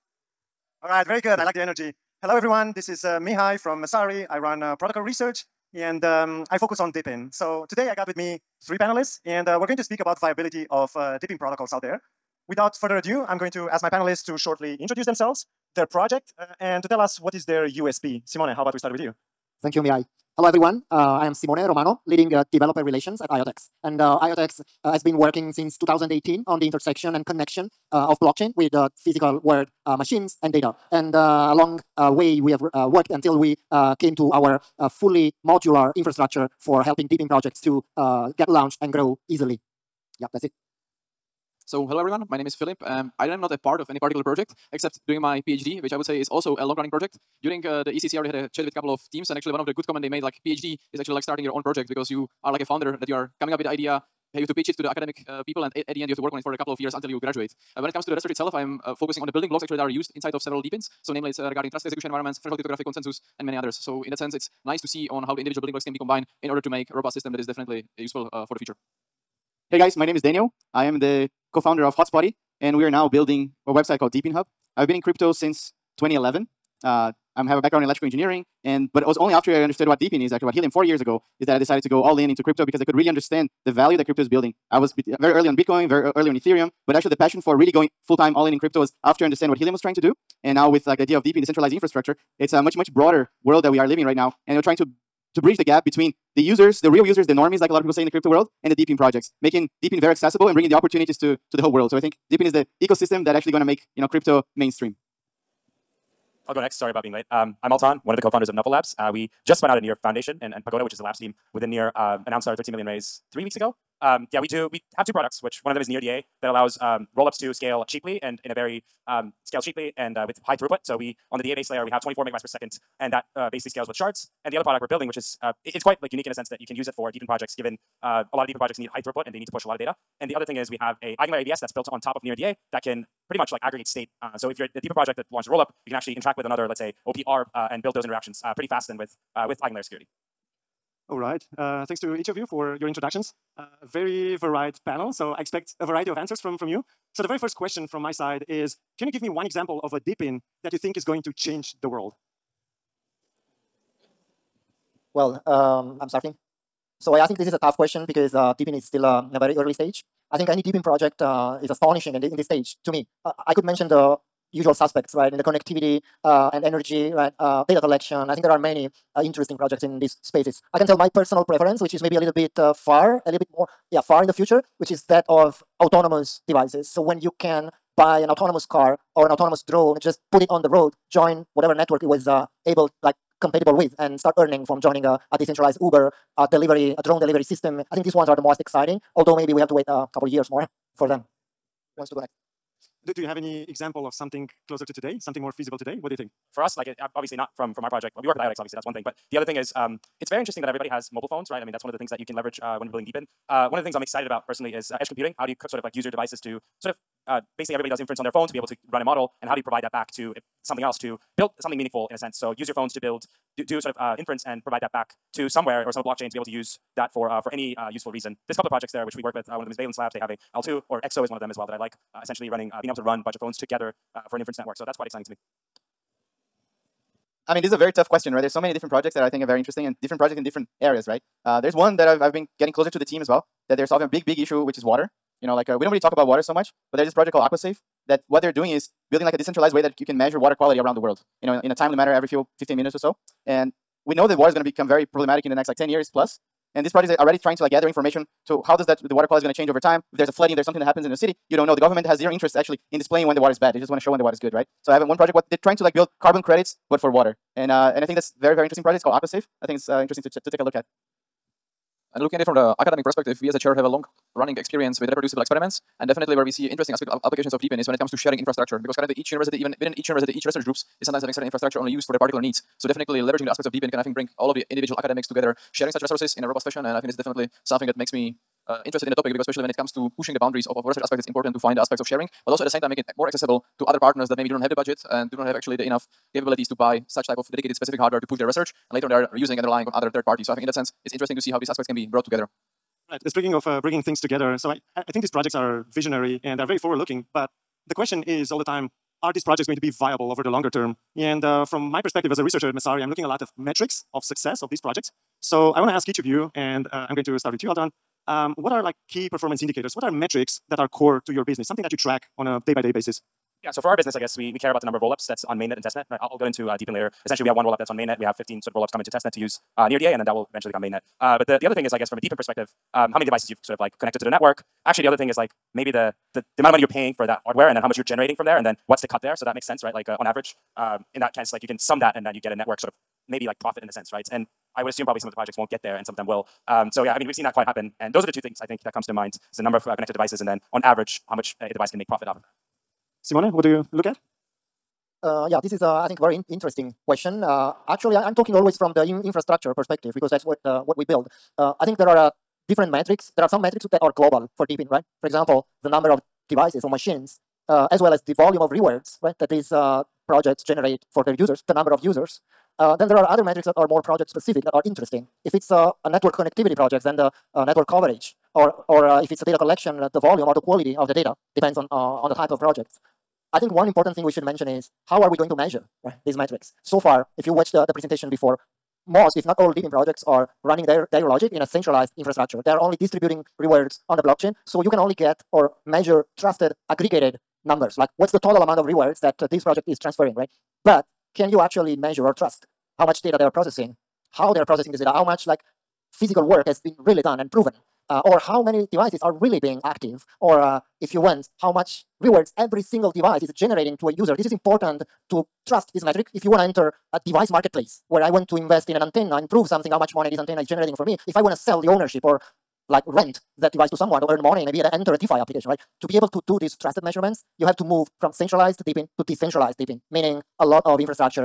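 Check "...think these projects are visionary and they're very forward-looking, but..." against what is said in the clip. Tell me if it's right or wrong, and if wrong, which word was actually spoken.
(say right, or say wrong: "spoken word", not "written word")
right.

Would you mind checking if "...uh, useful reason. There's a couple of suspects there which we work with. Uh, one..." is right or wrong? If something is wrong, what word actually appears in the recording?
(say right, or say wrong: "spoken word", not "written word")
wrong: "projects", not "suspects".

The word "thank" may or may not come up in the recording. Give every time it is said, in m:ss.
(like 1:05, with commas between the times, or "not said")
0:19, 2:21.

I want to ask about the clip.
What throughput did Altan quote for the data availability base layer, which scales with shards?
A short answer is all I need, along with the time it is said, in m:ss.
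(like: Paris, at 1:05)
24 megabytes per second, at 2:02.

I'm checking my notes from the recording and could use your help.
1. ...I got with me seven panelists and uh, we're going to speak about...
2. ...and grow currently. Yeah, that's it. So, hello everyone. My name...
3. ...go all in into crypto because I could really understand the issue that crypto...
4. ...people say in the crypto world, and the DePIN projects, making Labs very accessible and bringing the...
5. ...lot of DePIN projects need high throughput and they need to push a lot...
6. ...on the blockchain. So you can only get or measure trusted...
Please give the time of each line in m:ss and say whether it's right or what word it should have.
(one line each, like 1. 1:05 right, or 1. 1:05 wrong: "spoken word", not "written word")
1. 0:07 wrong: "three", not "seven"
2. 0:38 wrong: "easily", not "currently"
3. 1:21 wrong: "value", not "issue"
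4. 1:37 wrong: "DePIN", not "Labs"
5. 2:08 right
6. 6:24 right.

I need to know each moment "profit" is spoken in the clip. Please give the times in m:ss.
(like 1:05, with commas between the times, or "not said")
5:33, 5:42.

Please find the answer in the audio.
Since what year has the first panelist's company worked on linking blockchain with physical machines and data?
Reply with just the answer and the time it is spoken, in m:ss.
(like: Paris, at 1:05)
2018, at 0:25.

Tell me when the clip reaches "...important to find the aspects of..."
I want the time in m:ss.
4:41.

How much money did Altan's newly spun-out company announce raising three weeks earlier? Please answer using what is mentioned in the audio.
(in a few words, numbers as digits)
13 million.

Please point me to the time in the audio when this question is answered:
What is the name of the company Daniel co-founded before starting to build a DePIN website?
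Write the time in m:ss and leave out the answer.
1:11.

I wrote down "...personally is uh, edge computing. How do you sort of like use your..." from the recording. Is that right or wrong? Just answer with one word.
right.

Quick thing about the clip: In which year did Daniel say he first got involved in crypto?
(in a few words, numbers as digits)
2011.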